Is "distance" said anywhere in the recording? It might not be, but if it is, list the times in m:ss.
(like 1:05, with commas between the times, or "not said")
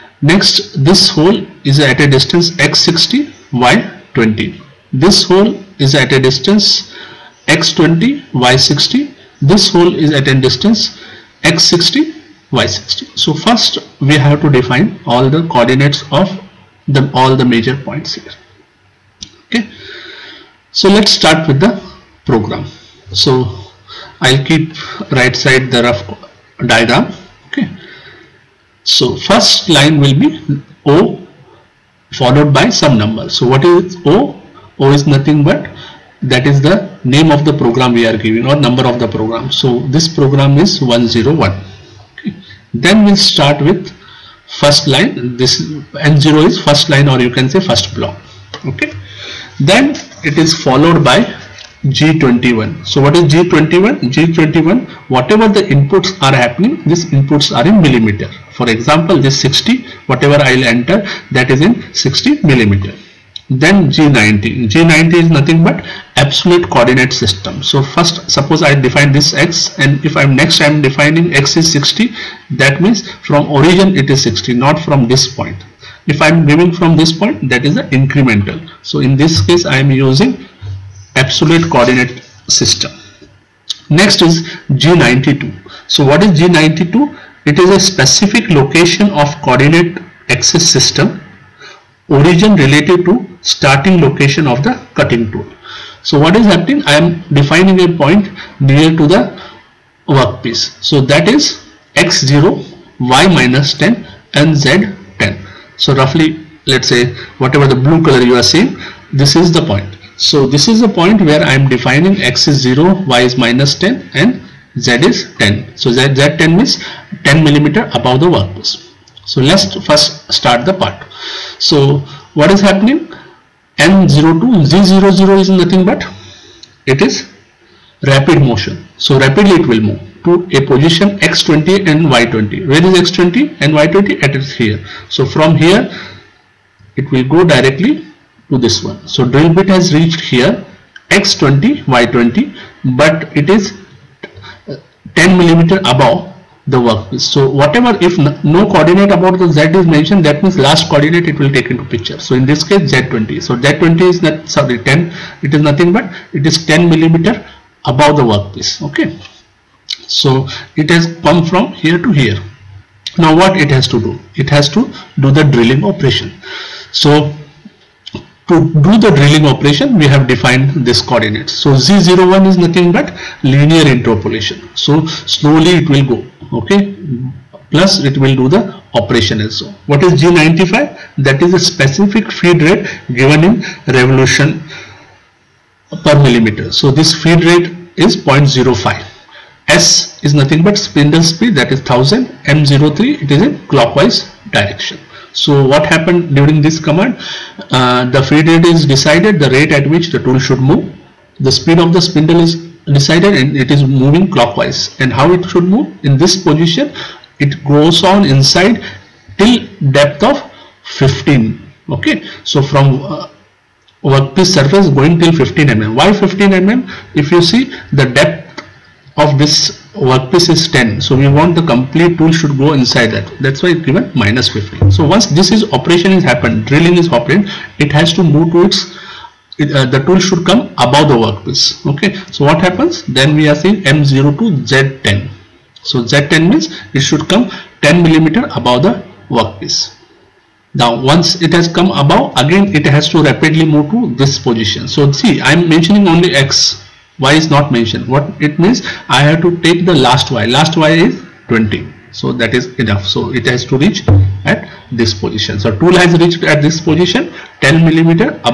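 0:02, 0:06, 0:10.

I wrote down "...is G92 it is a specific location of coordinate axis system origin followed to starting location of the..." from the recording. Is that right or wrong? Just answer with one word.
wrong.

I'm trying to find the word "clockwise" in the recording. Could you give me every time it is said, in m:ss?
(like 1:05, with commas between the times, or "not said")
3:13, 3:24.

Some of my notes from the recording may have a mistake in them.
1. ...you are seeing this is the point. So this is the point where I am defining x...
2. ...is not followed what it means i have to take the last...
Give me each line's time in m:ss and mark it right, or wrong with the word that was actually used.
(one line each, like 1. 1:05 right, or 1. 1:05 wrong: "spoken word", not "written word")
1. 1:48 right
2. 4:07 wrong: "mentioned", not "followed".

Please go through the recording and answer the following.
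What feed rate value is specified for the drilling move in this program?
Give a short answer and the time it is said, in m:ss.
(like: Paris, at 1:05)
0.05, at 3:08.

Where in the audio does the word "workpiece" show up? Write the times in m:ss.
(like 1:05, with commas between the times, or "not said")
1:40, 1:58, 2:26, 2:38, 3:34, 3:39, 3:51, 3:59.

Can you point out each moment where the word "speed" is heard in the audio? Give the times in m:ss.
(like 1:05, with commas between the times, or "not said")
3:11, 3:21.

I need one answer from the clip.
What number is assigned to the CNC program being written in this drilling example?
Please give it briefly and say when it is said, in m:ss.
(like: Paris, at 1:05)
101, at 0:40.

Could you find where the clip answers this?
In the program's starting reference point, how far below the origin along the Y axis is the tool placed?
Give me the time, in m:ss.
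1:42.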